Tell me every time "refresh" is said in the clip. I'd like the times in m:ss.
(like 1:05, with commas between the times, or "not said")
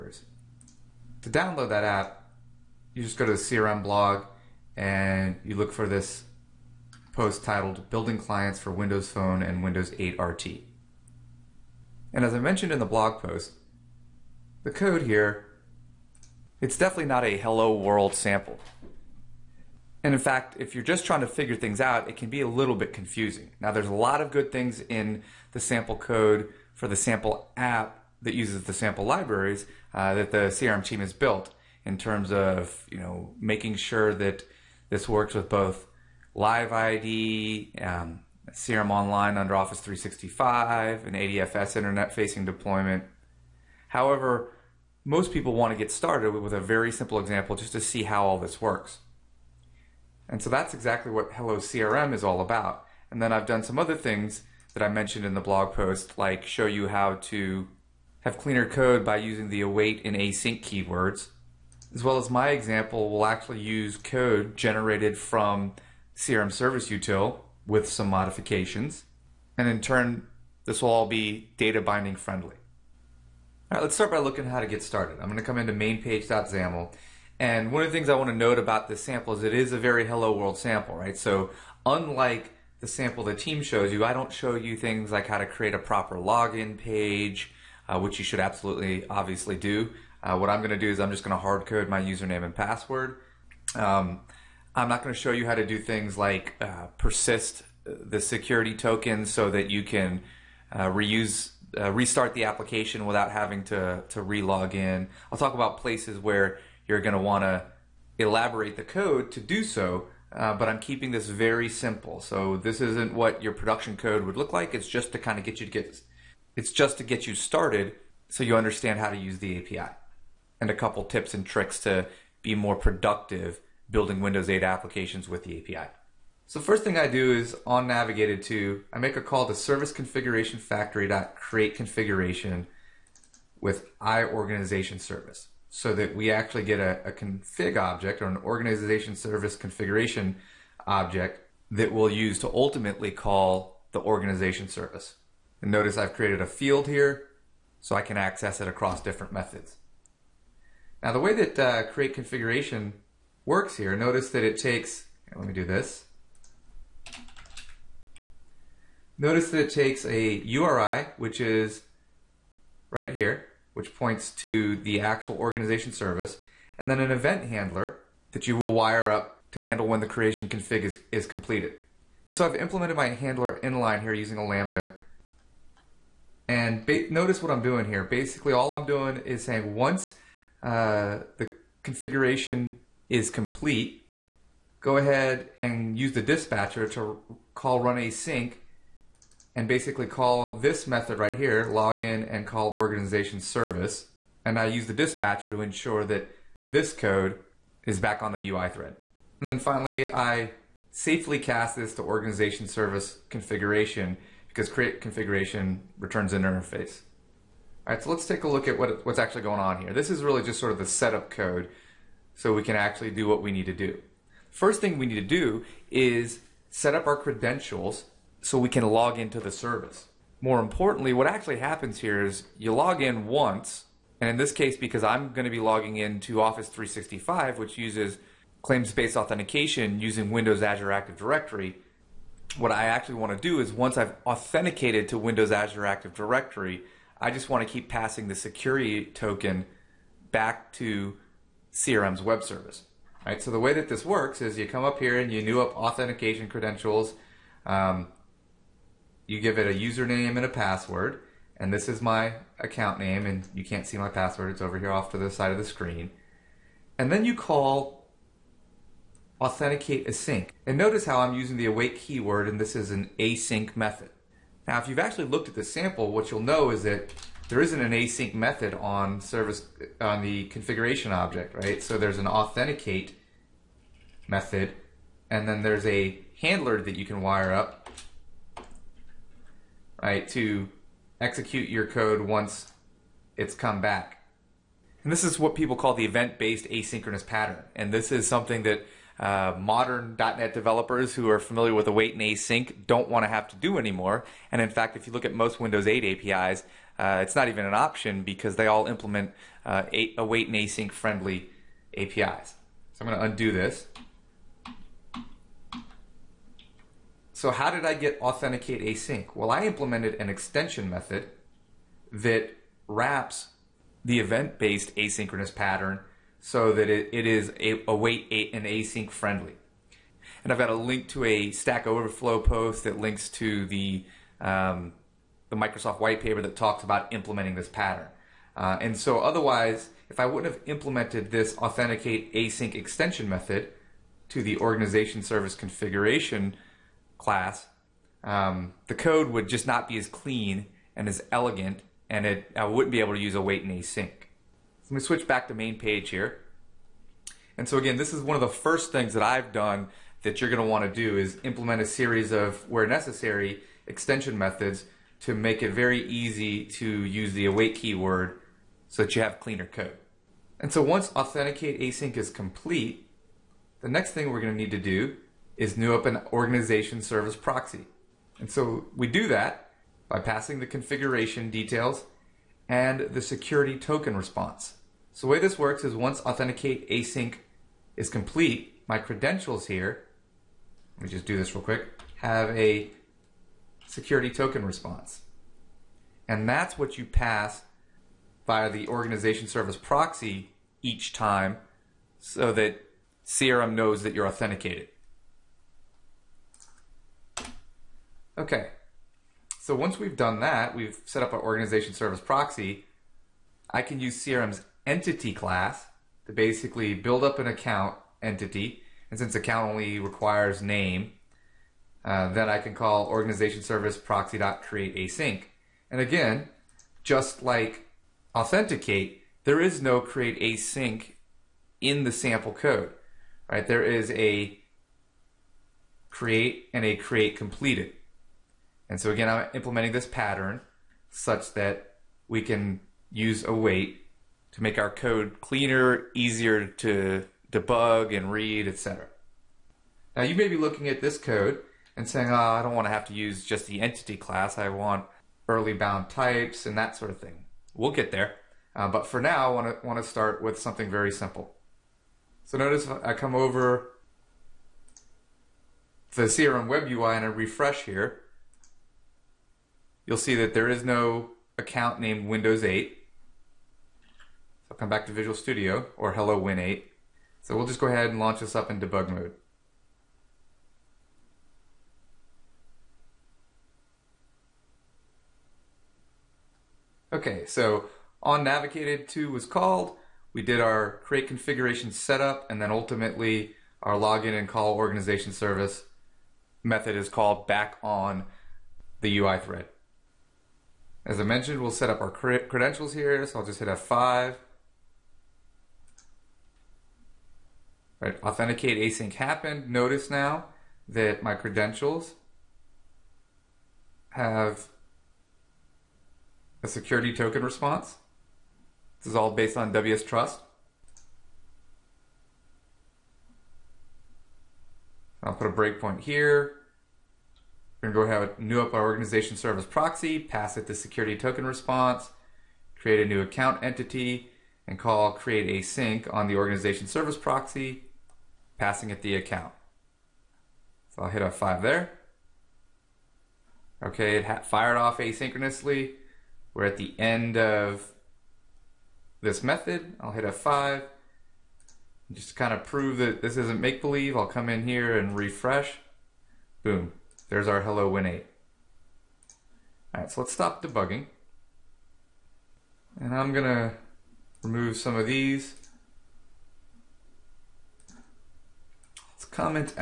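7:37, 9:05.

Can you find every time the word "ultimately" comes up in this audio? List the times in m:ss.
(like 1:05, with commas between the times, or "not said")
2:22, 8:02.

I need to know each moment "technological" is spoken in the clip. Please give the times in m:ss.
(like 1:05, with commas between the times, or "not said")
not said.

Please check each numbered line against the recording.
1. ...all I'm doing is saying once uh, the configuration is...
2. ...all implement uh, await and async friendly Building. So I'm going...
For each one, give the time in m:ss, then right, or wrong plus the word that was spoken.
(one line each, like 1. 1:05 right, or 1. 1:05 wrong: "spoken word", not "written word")
1. 2:58 right
2. 4:58 wrong: "APIs", not "Building".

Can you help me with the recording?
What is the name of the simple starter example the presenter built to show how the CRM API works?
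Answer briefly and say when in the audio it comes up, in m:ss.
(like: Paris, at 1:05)
Hello CRM, at 0:51.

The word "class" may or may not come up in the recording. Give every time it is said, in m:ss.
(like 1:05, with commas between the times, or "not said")
5:37, 6:45, 7:24.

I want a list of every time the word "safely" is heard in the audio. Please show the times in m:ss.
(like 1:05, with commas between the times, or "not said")
3:20.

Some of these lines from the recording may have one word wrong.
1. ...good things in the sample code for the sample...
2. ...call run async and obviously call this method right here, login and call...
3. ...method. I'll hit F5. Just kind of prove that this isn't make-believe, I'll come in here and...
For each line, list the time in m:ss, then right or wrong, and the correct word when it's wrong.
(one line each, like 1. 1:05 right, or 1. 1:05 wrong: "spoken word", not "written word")
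1. 0:24 right
2. 3:07 wrong: "basically", not "obviously"
3. 8:59 right.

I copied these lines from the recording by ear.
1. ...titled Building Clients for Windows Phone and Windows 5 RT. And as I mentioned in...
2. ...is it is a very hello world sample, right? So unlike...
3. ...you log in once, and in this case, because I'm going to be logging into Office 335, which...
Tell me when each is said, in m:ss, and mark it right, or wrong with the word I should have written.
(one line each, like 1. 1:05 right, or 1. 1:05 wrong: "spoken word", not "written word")
1. 0:07 wrong: "8", not "5"
2. 1:19 right
3. 3:42 wrong: "365", not "335".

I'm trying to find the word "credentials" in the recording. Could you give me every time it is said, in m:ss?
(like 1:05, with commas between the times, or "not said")
3:37, 4:06, 6:18, 8:12, 8:21.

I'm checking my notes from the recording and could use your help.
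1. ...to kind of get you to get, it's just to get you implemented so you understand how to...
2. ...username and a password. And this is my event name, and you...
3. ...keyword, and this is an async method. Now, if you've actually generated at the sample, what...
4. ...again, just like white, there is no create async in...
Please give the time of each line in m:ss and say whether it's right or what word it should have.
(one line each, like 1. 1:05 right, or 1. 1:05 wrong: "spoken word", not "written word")
1. 1:55 wrong: "started", not "implemented"
2. 4:09 wrong: "account", not "event"
3. 4:21 wrong: "looked", not "generated"
4. 6:55 wrong: "authenticate", not "white".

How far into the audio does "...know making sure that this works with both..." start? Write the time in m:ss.
0:32.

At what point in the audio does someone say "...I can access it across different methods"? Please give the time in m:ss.
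2:27.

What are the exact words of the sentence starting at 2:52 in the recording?
And so I've implemented my handler inline here using a lambda.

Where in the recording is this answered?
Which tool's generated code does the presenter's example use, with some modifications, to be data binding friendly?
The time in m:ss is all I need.
1:06.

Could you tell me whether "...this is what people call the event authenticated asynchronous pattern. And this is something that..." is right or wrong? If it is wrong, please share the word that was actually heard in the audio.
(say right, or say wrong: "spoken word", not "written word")
wrong: "based", not "authenticated".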